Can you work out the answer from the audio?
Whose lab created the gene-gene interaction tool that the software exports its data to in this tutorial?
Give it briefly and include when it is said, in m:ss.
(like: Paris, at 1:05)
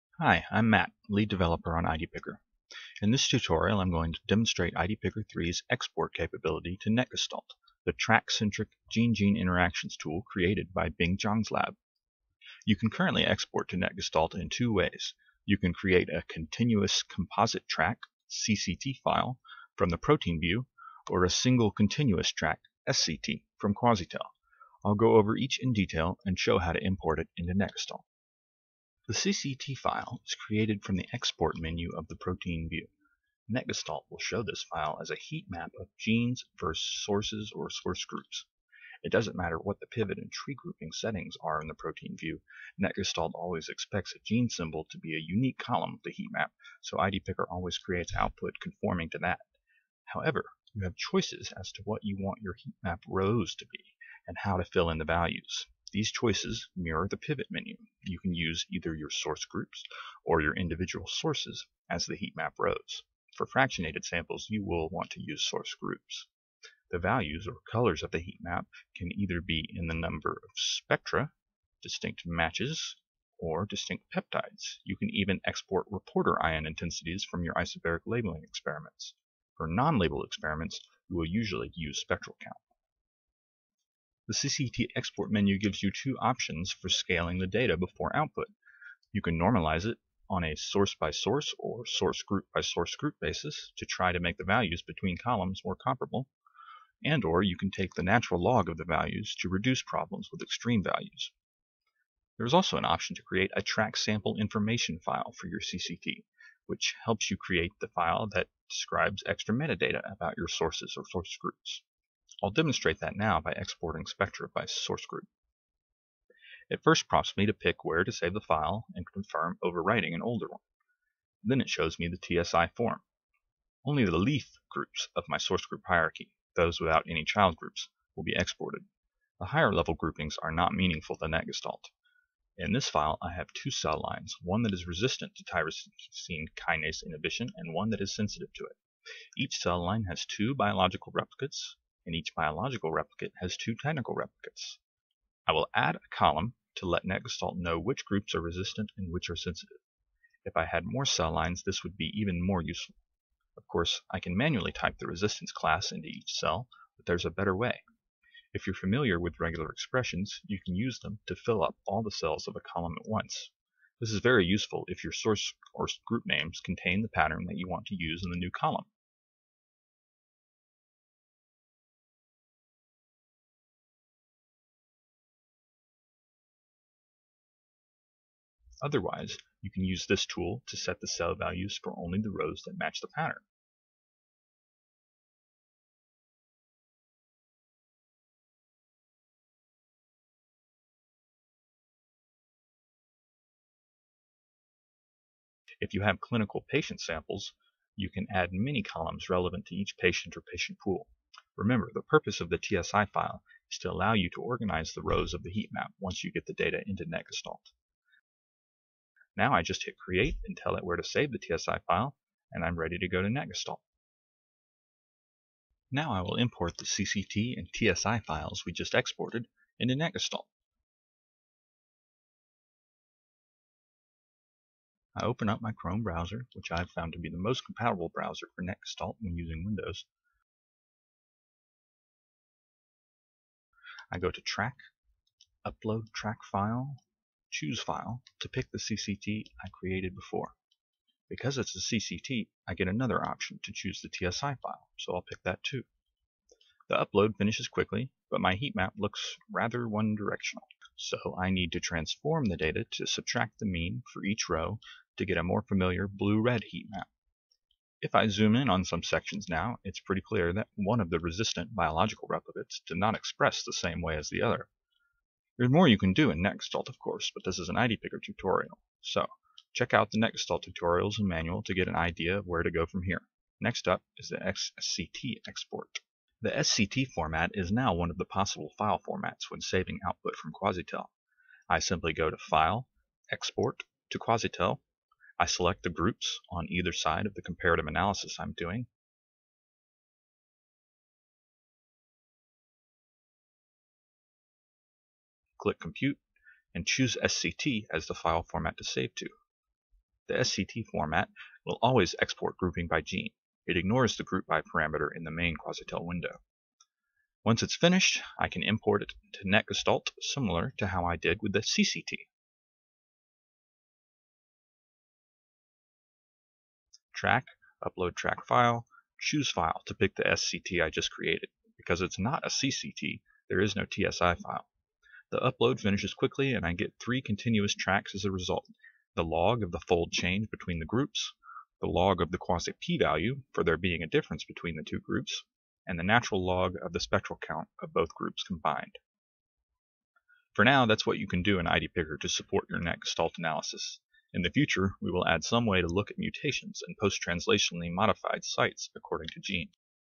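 Bing Zhang, at 0:10.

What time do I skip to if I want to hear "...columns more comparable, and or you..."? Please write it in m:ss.
1:35.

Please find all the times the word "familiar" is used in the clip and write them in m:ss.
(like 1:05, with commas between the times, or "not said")
2:38, 4:15.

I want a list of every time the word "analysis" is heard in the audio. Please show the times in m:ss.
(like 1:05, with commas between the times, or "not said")
4:47, 5:43.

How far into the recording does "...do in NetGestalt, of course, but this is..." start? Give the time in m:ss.
4:26.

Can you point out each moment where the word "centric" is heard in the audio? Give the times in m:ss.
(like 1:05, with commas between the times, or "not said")
0:07.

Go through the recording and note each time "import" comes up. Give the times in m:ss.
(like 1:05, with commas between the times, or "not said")
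0:26, 3:36, 5:08.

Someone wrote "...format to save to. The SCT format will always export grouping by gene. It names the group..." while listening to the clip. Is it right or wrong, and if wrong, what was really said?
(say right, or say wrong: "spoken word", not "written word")
wrong: "ignores", not "names".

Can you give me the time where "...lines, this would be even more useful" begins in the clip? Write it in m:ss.
2:31.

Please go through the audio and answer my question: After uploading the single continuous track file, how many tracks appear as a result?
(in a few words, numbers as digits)
3.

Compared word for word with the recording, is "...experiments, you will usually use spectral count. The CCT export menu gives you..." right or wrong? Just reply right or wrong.
right.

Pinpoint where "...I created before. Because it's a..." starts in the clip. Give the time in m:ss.
3:59.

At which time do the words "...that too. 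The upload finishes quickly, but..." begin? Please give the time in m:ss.
4:05.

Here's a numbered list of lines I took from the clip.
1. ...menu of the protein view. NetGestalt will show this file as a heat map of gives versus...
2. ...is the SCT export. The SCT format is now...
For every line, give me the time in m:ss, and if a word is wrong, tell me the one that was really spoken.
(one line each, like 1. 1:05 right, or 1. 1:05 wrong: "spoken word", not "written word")
1. 0:31 wrong: "genes", not "gives"
2. 4:34 right.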